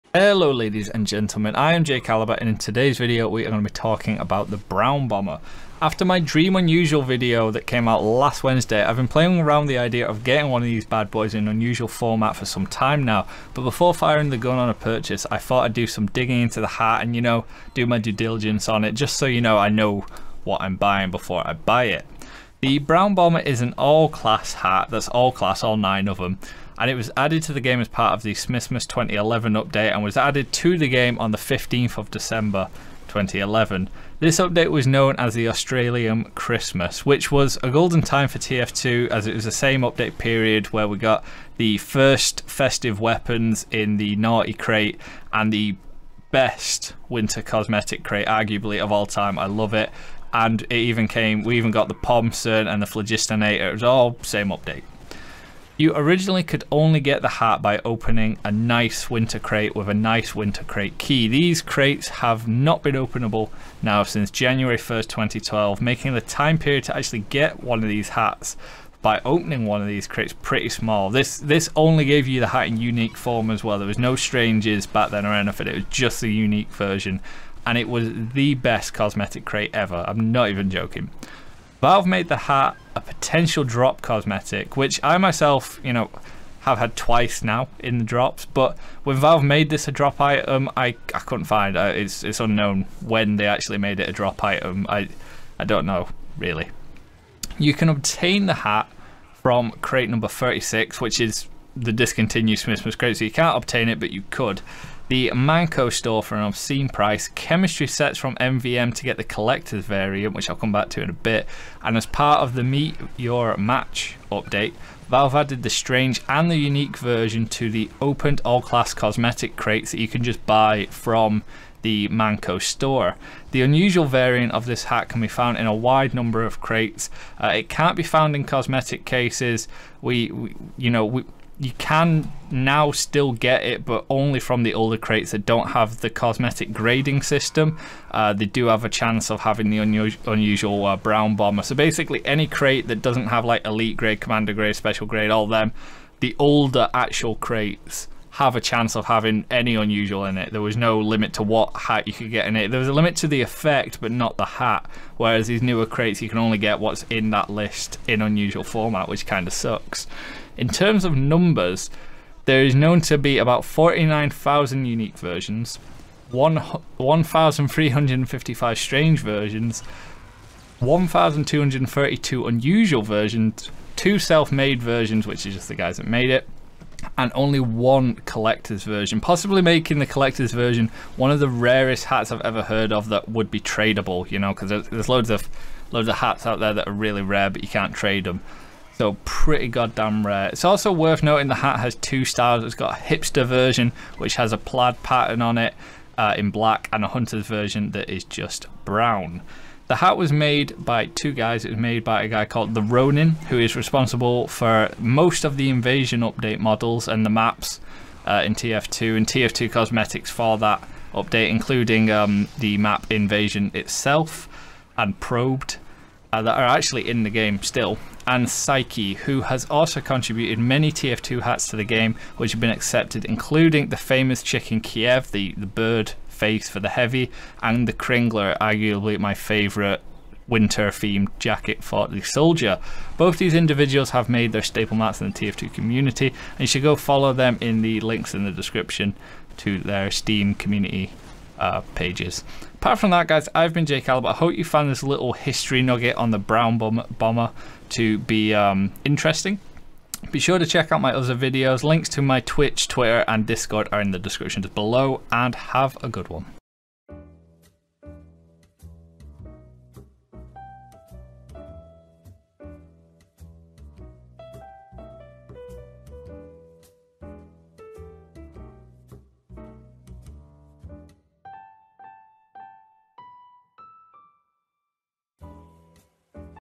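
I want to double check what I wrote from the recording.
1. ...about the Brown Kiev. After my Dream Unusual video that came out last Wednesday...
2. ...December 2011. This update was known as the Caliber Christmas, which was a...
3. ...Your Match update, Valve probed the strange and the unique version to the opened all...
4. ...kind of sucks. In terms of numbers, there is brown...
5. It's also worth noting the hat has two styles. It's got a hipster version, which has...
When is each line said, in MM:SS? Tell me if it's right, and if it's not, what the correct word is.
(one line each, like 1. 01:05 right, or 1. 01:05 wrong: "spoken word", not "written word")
1. 00:04 wrong: "Bomber", not "Kiev"
2. 00:32 wrong: "Australian", not "Caliber"
3. 01:53 wrong: "added", not "probed"
4. 02:39 wrong: "known", not "brown"
5. 03:10 right.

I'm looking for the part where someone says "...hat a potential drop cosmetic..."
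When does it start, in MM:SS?
01:22.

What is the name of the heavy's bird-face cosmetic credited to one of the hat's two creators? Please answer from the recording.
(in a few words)
Chicken Kiev.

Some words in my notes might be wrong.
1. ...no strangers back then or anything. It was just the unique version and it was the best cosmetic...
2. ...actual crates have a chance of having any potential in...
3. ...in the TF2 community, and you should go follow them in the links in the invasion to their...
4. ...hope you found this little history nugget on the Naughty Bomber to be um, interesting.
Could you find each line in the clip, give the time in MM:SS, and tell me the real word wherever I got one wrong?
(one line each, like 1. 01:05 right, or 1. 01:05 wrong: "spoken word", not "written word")
1. 01:13 right
2. 02:26 wrong: "unusual", not "potential"
3. 03:55 wrong: "description", not "invasion"
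4. 04:04 wrong: "Brown", not "Naughty".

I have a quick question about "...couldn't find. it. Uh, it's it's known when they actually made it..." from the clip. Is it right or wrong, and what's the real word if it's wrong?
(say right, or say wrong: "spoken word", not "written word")
wrong: "unknown", not "known".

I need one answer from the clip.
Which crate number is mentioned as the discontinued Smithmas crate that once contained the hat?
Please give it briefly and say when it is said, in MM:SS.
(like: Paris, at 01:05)
36, at 01:40.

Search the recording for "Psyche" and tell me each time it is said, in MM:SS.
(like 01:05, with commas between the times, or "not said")
03:38.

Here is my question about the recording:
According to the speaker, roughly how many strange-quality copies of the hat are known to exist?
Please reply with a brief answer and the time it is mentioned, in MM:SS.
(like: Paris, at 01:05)
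1,355, at 02:46.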